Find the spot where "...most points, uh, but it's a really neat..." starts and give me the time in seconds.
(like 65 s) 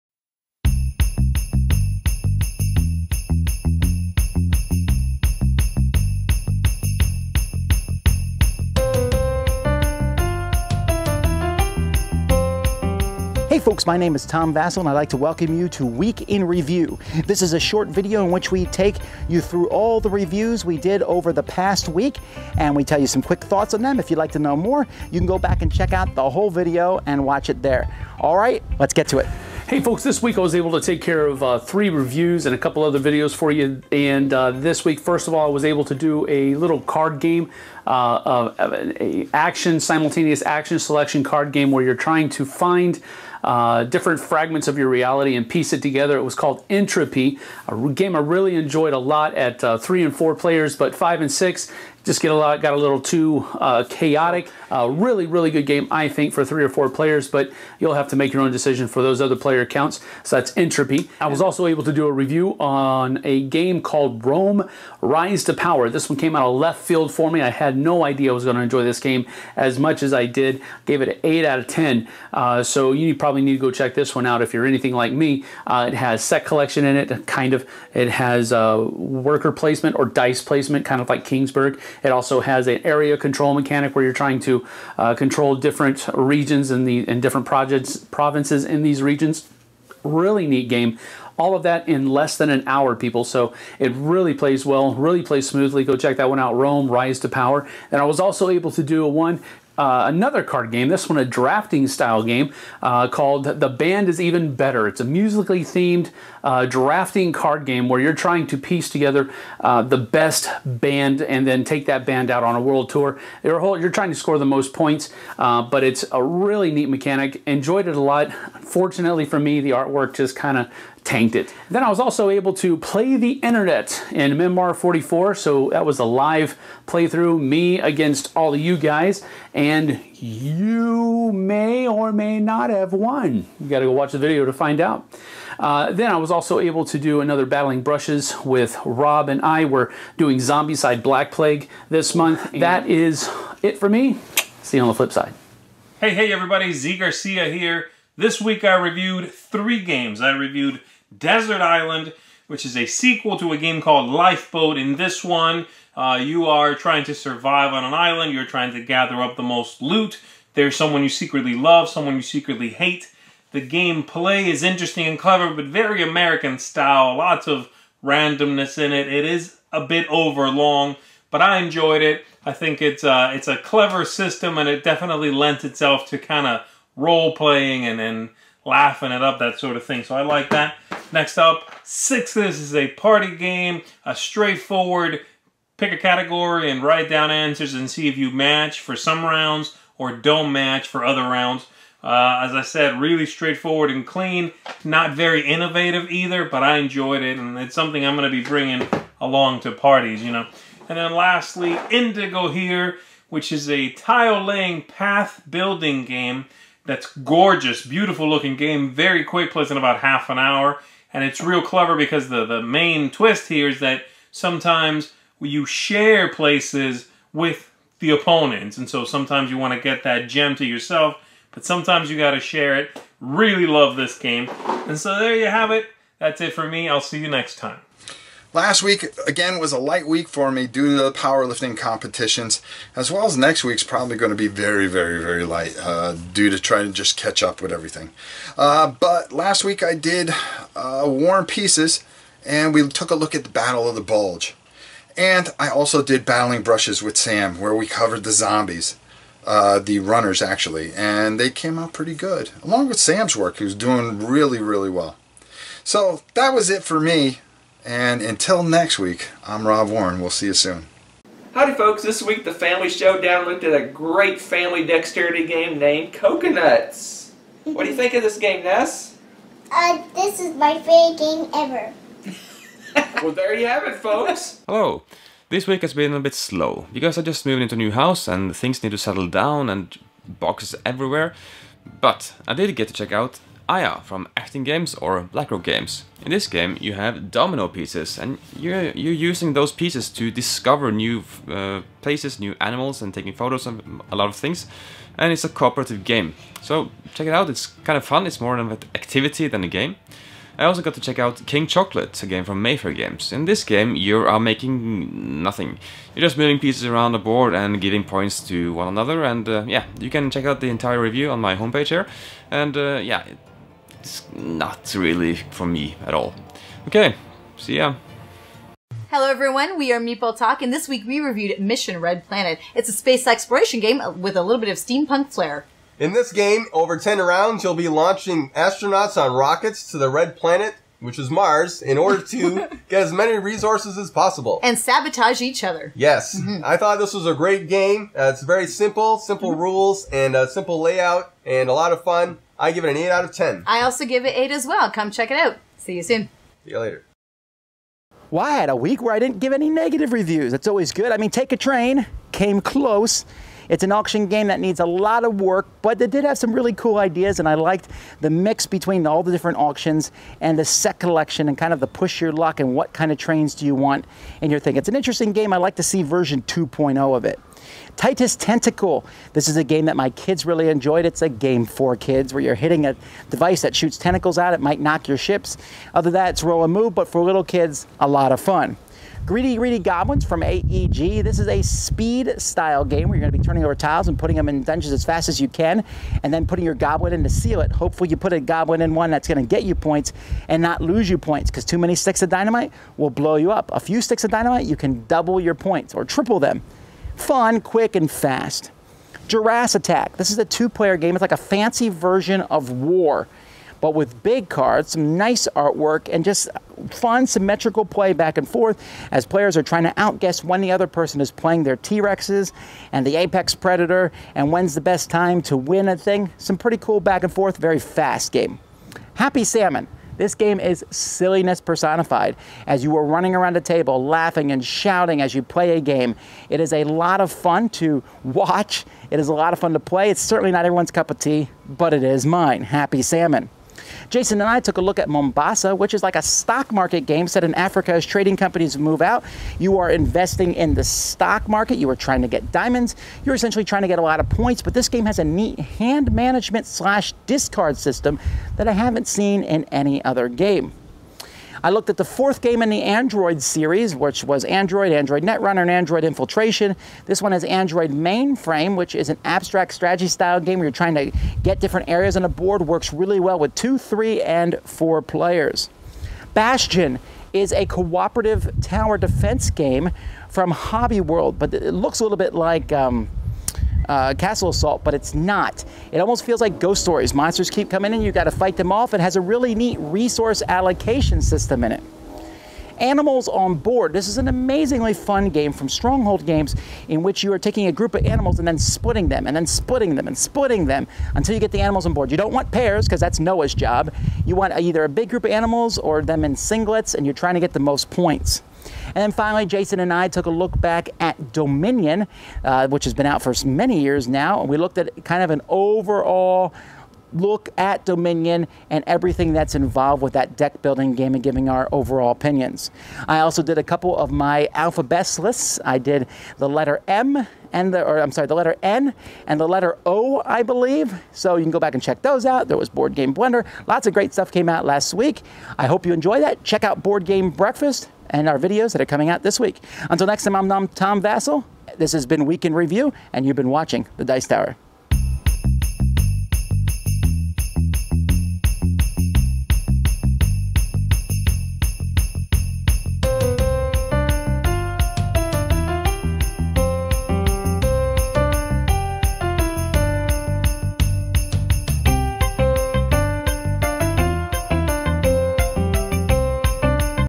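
114 s.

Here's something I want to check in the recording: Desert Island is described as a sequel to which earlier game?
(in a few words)
Lifeboat.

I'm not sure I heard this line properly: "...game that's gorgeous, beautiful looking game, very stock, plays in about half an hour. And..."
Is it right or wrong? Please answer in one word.
wrong.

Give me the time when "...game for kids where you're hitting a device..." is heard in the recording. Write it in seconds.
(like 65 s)
371 s.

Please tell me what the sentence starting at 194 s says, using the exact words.
Not very innovative either, but I enjoyed it, and it's something I'm going to be bringing along to parties, you know.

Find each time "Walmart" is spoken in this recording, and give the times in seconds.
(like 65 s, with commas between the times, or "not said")
not said.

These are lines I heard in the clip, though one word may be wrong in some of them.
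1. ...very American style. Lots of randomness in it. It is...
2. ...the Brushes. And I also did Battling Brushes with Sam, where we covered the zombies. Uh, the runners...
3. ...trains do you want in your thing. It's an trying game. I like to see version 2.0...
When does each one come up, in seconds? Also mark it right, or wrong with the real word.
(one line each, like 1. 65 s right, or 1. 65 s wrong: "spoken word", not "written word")
1. 165 s right
2. 243 s wrong: "Bulge", not "Brushes"
3. 363 s wrong: "interesting", not "trying".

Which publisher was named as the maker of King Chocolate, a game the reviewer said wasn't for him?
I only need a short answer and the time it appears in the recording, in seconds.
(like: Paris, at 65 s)
Mayfair Games, at 302 s.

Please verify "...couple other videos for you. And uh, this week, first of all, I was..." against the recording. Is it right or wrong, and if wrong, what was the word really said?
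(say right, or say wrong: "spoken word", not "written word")
right.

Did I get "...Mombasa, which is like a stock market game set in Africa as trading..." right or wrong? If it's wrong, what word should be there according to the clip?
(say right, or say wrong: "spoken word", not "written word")
right.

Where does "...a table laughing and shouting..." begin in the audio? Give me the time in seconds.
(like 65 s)
423 s.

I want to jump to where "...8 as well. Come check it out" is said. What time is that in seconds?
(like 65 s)
344 s.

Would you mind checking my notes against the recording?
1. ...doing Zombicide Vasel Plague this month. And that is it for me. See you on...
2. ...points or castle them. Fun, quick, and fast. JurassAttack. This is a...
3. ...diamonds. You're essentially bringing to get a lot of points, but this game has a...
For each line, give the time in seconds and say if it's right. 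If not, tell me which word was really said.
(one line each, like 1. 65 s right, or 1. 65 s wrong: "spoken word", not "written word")
1. 140 s wrong: "Black", not "Vasel"
2. 395 s wrong: "triple", not "castle"
3. 442 s wrong: "trying", not "bringing".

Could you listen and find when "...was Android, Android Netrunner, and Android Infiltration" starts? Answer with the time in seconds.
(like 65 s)
454 s.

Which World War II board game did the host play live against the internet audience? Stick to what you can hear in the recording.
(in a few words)
Memoir 44.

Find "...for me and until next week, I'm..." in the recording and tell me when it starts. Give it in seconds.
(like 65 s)
256 s.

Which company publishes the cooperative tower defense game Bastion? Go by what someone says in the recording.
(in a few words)
Hobby World.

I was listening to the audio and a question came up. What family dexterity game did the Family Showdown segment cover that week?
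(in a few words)
Coconuts.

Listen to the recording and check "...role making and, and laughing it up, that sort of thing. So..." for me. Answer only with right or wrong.
wrong.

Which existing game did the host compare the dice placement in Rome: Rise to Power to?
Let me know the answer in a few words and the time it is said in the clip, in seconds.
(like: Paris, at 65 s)
Kingsburg, at 81 s.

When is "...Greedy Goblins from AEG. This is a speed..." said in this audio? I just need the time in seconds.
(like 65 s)
379 s.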